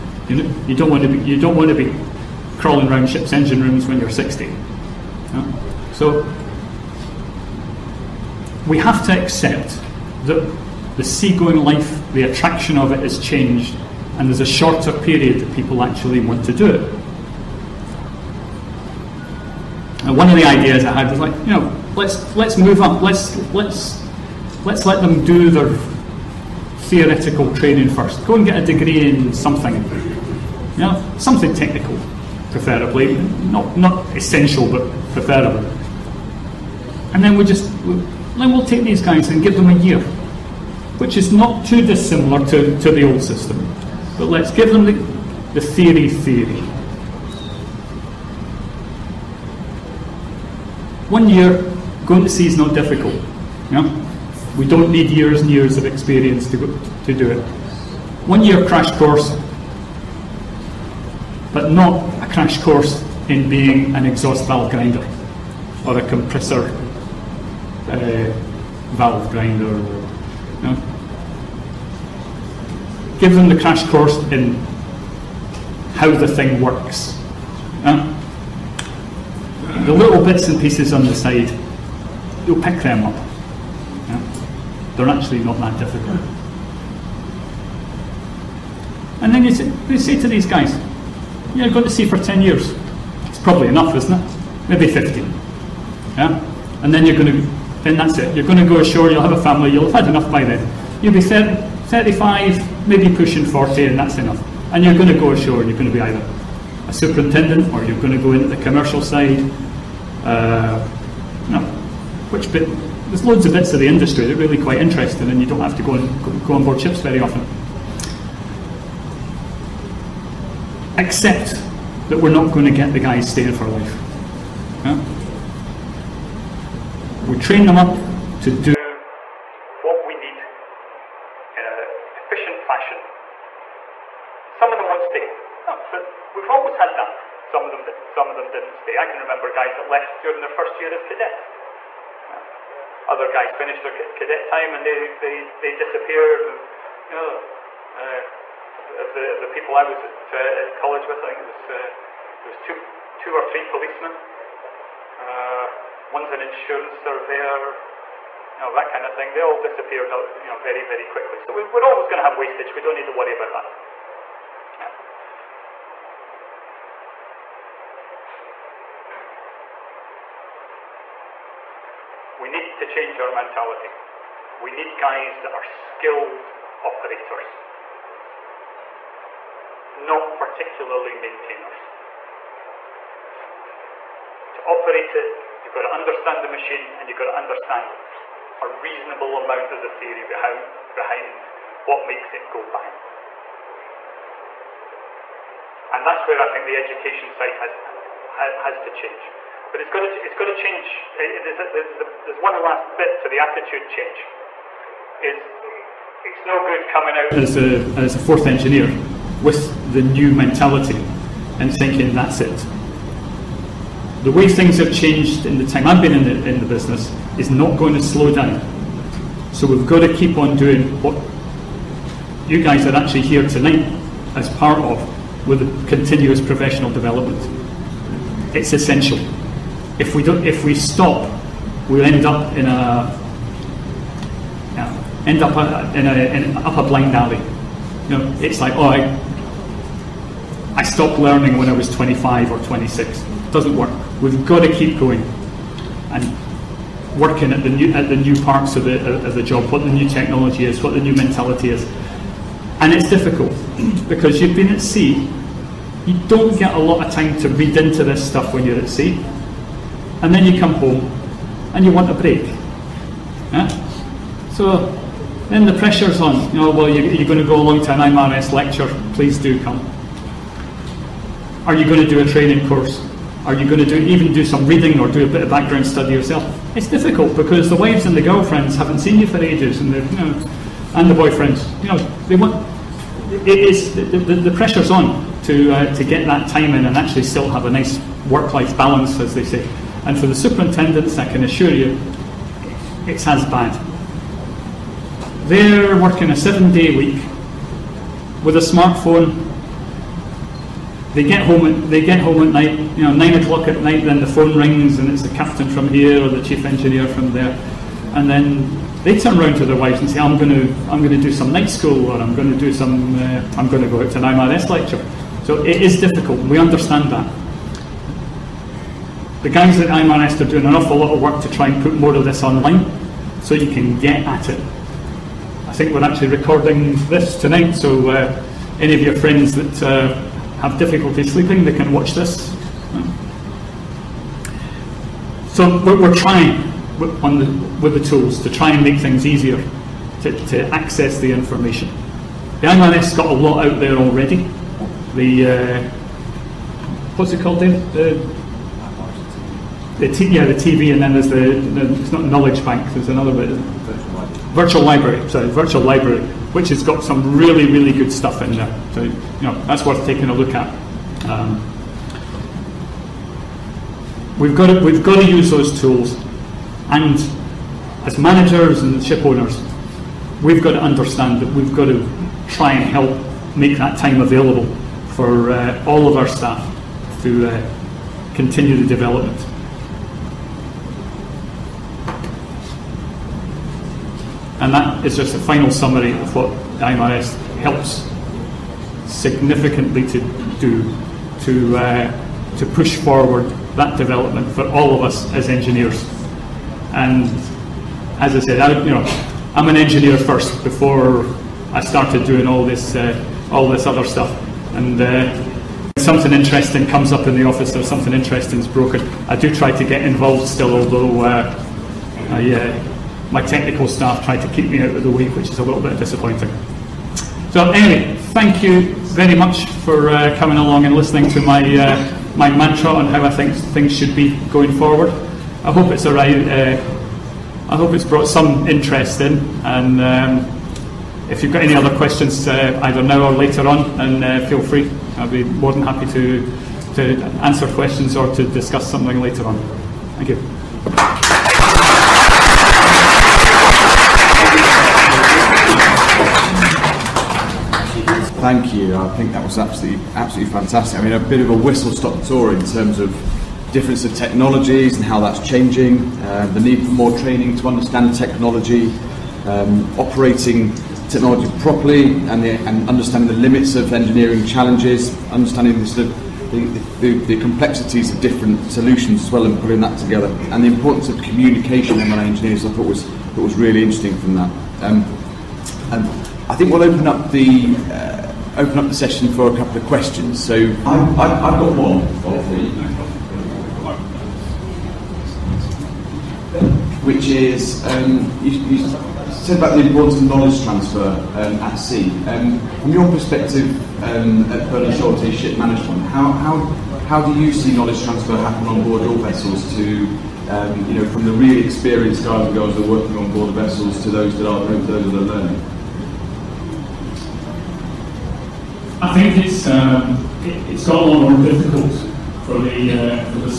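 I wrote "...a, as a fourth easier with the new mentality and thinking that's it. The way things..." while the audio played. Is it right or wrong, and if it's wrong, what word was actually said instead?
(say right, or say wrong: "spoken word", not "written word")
wrong: "engineer", not "easier".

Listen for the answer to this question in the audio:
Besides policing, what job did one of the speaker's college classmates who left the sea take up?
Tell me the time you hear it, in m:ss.
2:36.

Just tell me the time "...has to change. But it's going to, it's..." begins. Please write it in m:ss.
3:18.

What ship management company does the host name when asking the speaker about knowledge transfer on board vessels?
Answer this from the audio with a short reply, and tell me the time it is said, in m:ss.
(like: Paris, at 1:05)
Bernhard Schulte Ship Management, at 8:14.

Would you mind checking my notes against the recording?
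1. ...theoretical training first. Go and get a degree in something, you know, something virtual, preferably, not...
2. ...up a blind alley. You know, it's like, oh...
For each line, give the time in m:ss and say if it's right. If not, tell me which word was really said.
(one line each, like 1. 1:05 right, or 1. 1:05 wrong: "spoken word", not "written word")
1. 0:26 wrong: "technical", not "virtual"
2. 3:56 right.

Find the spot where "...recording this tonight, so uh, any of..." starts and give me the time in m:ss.
5:26.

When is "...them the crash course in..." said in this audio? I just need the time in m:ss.
1:13.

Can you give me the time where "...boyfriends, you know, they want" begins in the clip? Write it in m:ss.
4:41.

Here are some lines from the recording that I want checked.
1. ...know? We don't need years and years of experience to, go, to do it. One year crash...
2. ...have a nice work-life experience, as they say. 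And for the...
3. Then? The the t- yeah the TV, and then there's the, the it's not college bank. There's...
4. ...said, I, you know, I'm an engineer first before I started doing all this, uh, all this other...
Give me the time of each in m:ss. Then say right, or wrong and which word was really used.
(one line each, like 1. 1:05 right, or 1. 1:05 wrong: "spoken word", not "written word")
1. 0:53 right
2. 4:47 wrong: "balance", not "experience"
3. 5:47 wrong: "knowledge", not "college"
4. 6:38 right.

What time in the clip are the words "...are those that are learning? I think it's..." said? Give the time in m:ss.
8:24.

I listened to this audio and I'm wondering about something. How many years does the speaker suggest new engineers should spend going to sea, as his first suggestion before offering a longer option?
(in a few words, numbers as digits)
10 years.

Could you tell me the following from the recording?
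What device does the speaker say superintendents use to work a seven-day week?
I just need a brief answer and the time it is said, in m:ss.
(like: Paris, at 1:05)
A smartphone, at 4:58.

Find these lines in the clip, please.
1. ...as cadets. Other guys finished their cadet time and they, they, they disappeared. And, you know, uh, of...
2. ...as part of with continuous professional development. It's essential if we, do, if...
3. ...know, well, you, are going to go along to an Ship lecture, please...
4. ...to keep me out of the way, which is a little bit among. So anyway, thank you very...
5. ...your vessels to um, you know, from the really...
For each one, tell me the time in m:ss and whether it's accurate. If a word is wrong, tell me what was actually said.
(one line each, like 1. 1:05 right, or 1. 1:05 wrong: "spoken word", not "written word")
1. 2:20 right
2. 3:44 right
3. 4:26 wrong: "IMarEST", not "Ship"
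4. 6:54 wrong: "disappointing", not "among"
5. 8:19 right.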